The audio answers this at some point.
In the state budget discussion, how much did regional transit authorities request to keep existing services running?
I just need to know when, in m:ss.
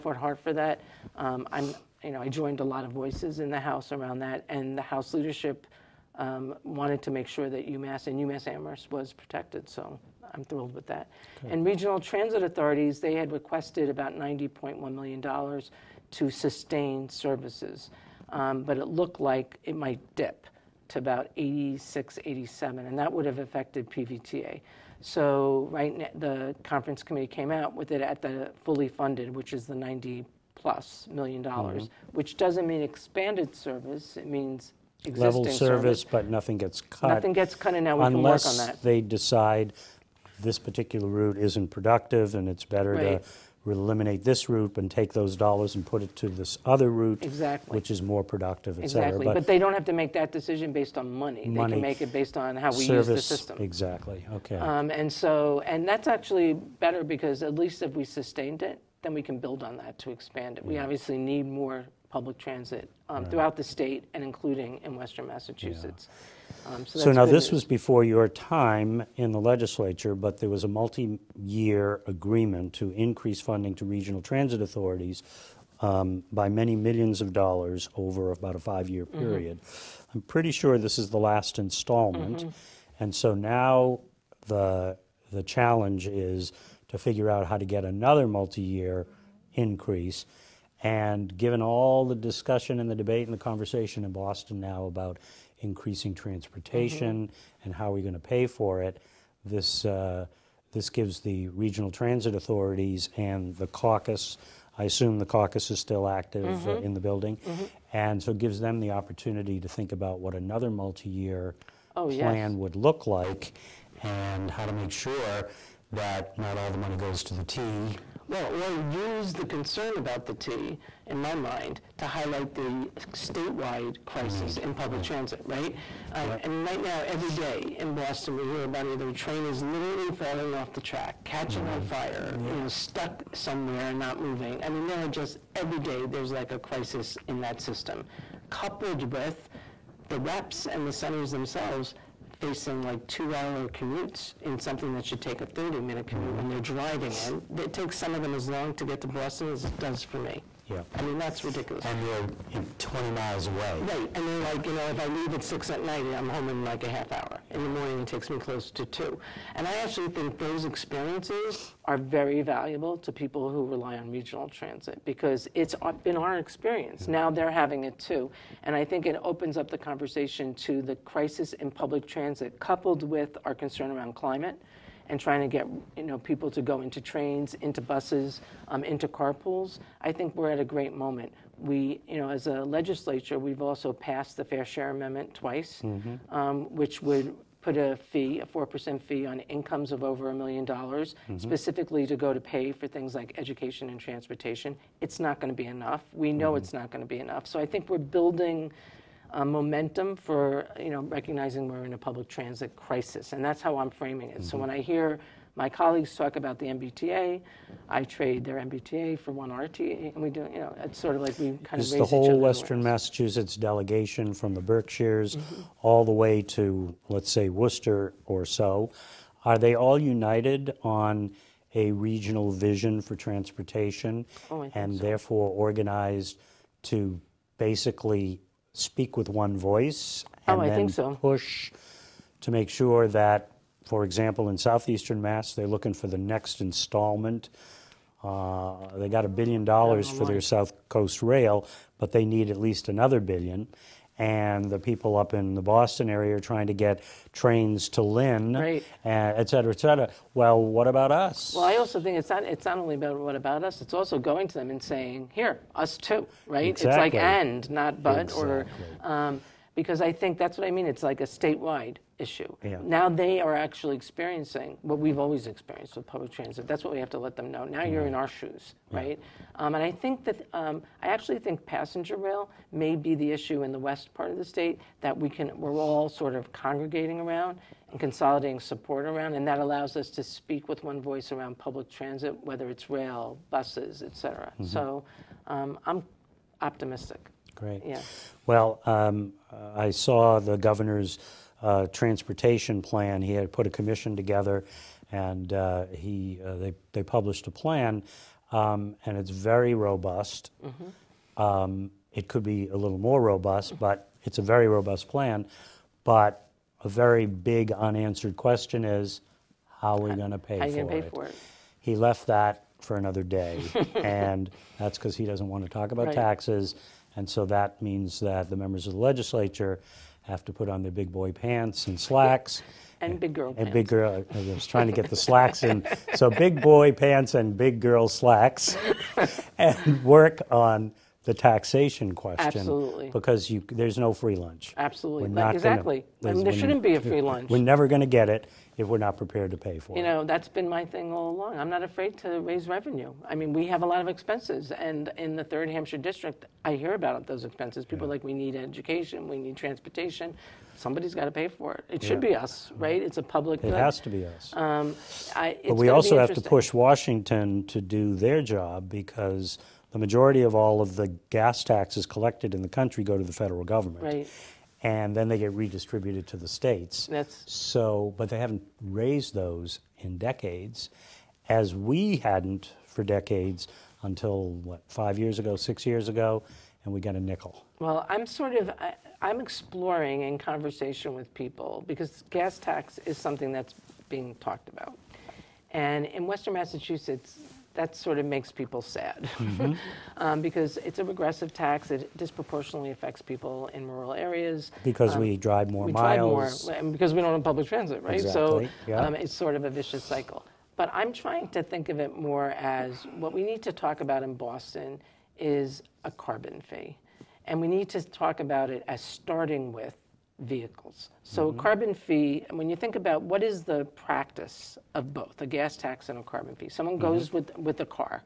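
0:14.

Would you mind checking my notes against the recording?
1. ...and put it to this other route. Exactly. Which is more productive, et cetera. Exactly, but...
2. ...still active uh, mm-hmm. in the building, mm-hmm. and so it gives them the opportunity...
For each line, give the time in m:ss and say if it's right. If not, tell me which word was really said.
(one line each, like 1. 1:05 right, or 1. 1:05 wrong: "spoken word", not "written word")
1. 0:45 right
2. 1:45 right.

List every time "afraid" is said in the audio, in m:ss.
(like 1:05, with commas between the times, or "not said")
5:41.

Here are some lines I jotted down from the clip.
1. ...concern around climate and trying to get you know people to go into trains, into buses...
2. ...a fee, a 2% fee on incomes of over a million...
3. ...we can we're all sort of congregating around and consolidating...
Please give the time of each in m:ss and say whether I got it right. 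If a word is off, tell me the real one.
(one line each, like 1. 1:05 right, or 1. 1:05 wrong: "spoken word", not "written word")
1. 2:53 right
2. 3:07 wrong: "4", not "2"
3. 4:35 right.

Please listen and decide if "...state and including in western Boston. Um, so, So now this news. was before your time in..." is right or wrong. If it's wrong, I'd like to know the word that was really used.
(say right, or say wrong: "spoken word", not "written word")
wrong: "Massachusetts", not "Boston".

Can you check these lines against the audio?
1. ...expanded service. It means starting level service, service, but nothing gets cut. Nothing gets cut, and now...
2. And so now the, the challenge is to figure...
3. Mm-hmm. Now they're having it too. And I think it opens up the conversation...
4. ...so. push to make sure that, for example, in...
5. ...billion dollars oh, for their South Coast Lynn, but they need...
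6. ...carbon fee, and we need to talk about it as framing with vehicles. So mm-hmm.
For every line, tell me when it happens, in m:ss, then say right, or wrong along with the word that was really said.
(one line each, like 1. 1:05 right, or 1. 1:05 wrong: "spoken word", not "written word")
1. 0:32 wrong: "existing", not "starting"
2. 1:23 right
3. 2:47 right
4. 3:50 right
5. 3:59 wrong: "Rail", not "Lynn"
6. 6:46 wrong: "starting", not "framing".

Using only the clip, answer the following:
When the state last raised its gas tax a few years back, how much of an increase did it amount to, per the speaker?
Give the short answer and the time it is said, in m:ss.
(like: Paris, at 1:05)
a nickel, at 6:17.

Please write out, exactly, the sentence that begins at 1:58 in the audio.
Well, or use the concern about the T in my mind, to highlight the statewide crisis Need.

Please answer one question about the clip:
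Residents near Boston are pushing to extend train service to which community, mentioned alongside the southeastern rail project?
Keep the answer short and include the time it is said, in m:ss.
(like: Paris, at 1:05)
Lynn, at 4:08.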